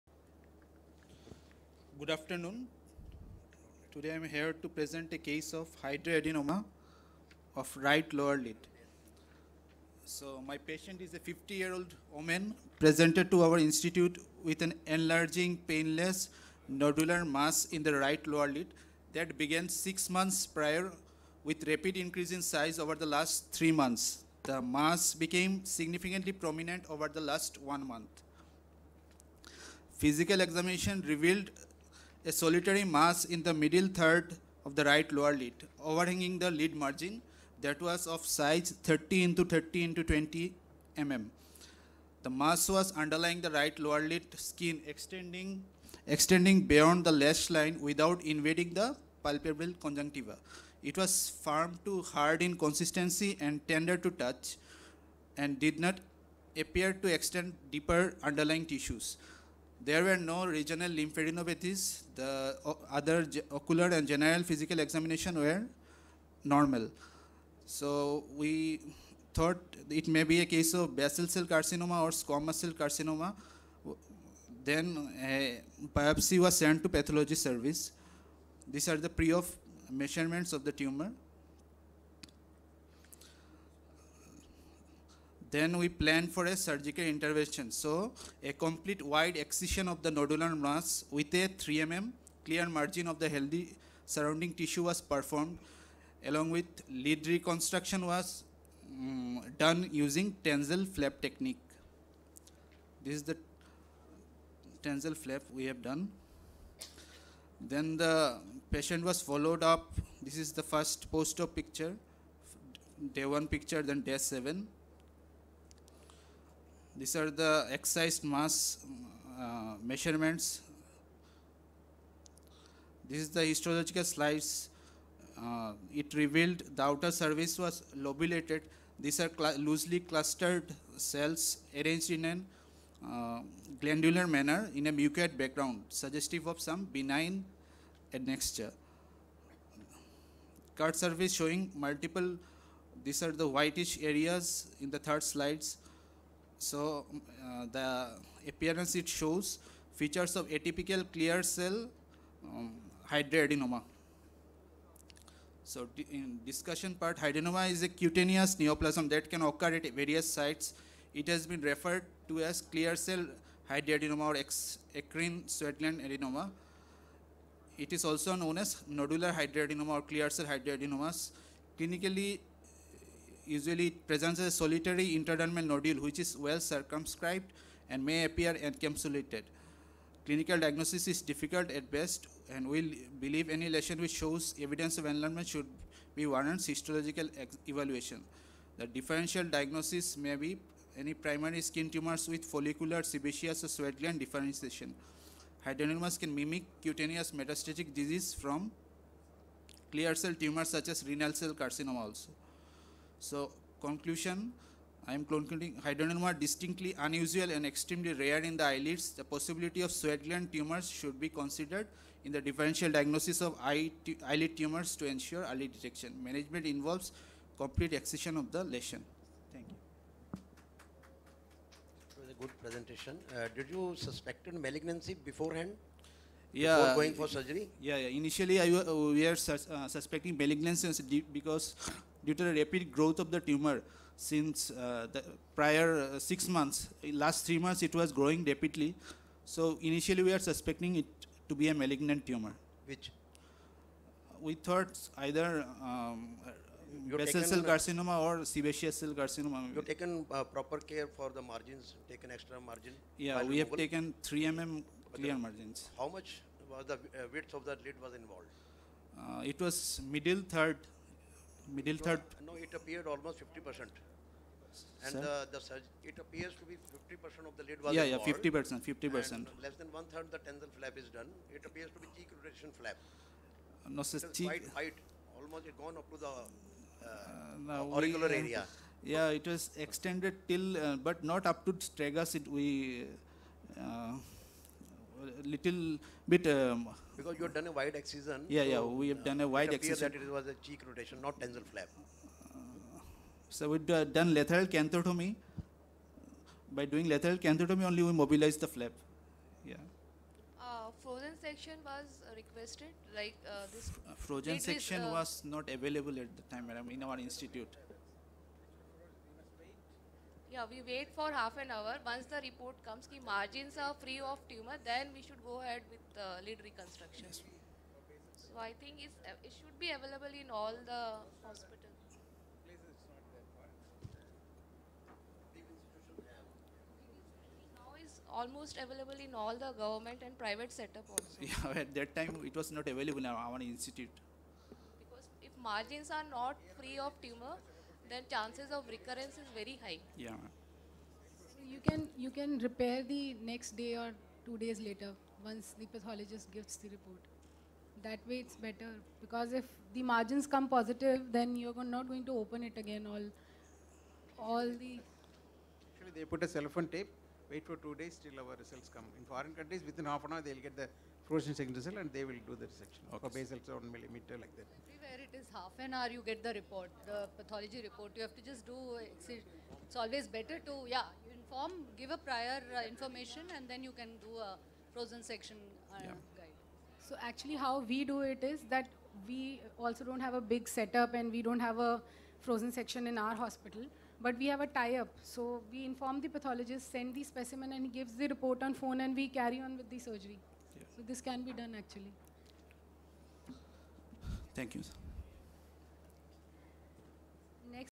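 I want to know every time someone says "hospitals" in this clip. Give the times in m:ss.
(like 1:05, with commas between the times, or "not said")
5:21, 6:23.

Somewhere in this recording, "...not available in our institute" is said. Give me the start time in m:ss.
5:32.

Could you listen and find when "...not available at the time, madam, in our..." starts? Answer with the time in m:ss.
5:05.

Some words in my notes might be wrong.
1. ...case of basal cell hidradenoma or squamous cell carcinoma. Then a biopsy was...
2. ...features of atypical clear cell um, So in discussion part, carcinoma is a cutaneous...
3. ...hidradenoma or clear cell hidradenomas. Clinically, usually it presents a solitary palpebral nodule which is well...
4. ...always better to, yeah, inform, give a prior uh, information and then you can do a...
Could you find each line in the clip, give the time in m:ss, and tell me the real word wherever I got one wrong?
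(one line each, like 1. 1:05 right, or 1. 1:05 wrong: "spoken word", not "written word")
1. 1:10 wrong: "carcinoma", not "hidradenoma"
2. 2:29 wrong: "hidradenoma", not "carcinoma"
3. 2:49 wrong: "intradermal", not "palpebral"
4. 6:09 right.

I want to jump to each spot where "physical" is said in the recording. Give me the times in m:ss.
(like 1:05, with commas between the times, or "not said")
0:29, 1:04.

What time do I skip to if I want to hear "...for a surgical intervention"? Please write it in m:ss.
1:26.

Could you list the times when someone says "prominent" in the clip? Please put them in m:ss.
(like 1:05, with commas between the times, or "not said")
0:26.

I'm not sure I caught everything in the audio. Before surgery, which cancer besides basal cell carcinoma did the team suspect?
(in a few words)
sebaceous cell carcinoma.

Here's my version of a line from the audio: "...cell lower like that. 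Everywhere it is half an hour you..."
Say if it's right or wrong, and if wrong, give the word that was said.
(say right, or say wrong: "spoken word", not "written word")
wrong: "millimeter", not "lower".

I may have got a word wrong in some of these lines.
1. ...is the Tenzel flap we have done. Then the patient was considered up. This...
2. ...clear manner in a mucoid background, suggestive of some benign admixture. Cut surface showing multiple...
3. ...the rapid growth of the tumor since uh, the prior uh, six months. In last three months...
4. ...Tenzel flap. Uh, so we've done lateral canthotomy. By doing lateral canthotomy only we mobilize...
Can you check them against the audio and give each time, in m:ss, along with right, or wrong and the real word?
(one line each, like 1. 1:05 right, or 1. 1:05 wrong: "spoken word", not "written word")
1. 1:43 wrong: "followed", not "considered"
2. 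2:13 wrong: "glandular", not "clear"
3. 3:52 right
4. 4:51 right.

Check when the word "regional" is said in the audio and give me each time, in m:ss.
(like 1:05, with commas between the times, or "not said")
1:00.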